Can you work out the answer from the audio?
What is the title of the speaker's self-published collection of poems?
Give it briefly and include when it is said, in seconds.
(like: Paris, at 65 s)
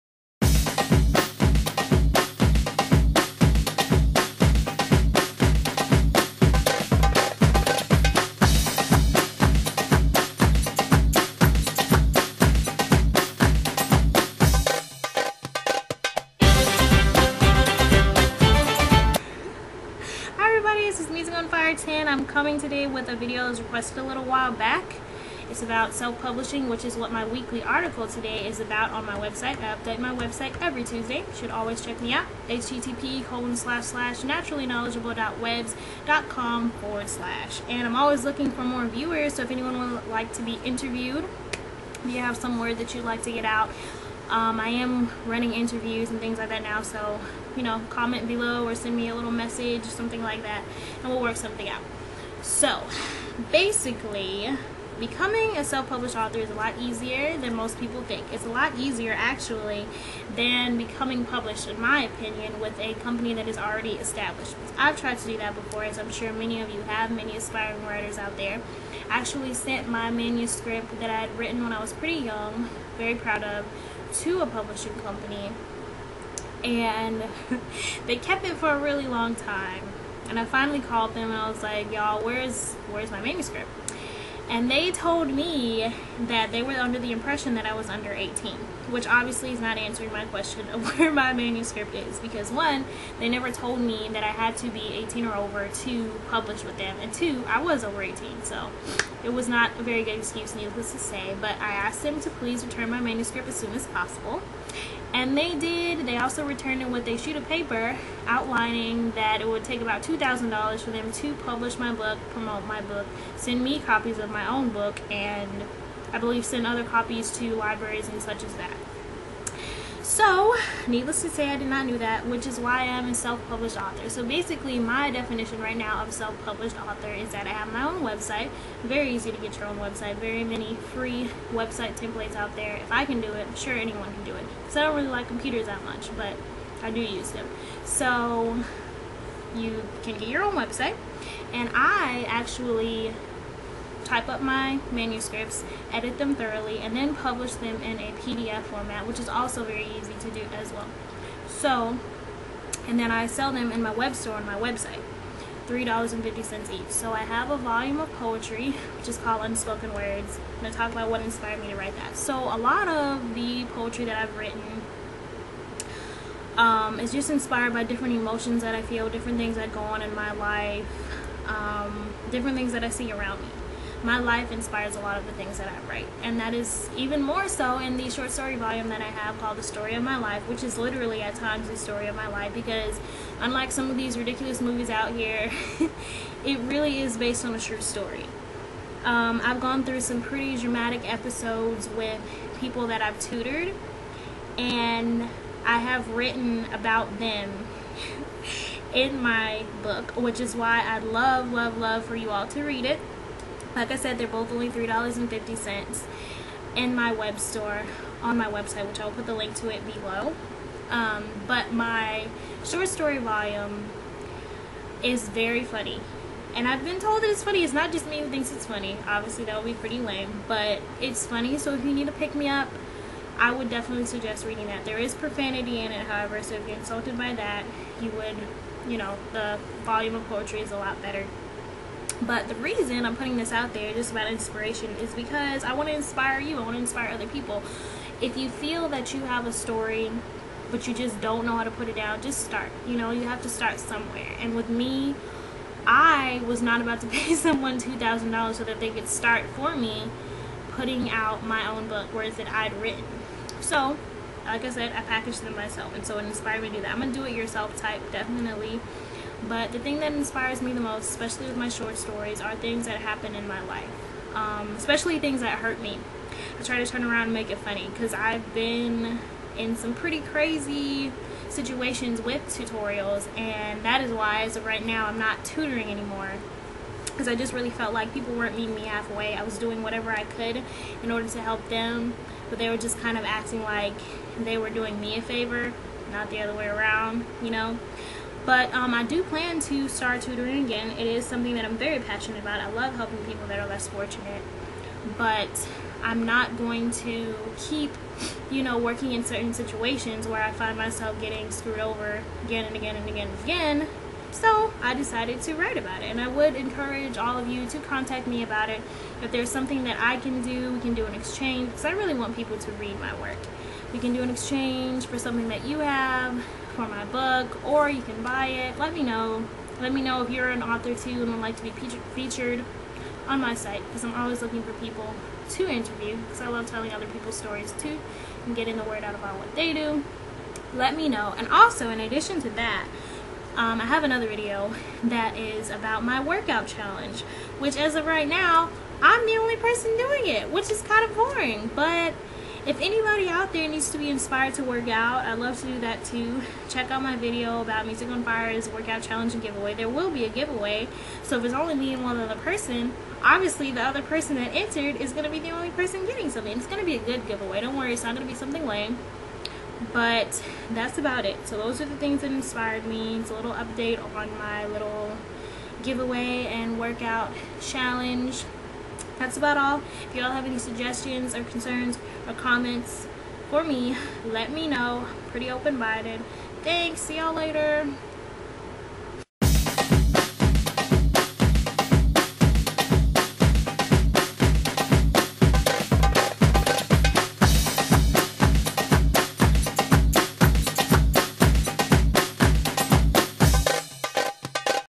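Unspoken Words, at 159 s.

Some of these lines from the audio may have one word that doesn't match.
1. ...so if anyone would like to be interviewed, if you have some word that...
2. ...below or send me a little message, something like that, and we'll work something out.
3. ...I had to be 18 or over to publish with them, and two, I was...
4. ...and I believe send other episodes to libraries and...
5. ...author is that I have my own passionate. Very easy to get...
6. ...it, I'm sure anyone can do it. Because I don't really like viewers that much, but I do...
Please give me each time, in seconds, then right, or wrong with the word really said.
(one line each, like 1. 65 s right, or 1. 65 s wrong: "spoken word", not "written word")
1. 39 s right
2. 48 s right
3. 94 s right
4. 115 s wrong: "copies", not "episodes"
5. 126 s wrong: "website", not "passionate"
6. 133 s wrong: "computers", not "viewers".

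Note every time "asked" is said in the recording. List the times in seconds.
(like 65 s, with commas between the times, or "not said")
101 s.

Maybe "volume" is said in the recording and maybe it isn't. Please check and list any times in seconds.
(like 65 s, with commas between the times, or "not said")
157 s, 178 s, 213 s, 229 s.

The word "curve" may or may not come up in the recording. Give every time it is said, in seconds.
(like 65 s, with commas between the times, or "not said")
not said.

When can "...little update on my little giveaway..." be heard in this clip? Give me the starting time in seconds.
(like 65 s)
363 s.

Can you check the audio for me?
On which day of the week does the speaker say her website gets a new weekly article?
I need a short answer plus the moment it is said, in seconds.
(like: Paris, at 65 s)
Tuesday, at 30 s.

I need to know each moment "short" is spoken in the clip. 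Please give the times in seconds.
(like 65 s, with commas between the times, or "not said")
178 s, 212 s, 261 s.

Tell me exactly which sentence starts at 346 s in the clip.
Check out my video about Music on Fire's workout challenge and giveaway.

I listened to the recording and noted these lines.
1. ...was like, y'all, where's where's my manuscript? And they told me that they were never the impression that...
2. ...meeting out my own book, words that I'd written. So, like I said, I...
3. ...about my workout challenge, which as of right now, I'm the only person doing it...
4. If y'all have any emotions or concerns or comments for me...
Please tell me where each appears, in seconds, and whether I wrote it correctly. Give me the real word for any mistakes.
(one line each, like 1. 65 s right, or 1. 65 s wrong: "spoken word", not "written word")
1. 81 s wrong: "under", not "never"
2. 250 s wrong: "putting", not "meeting"
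3. 335 s right
4. 370 s wrong: "suggestions", not "emotions".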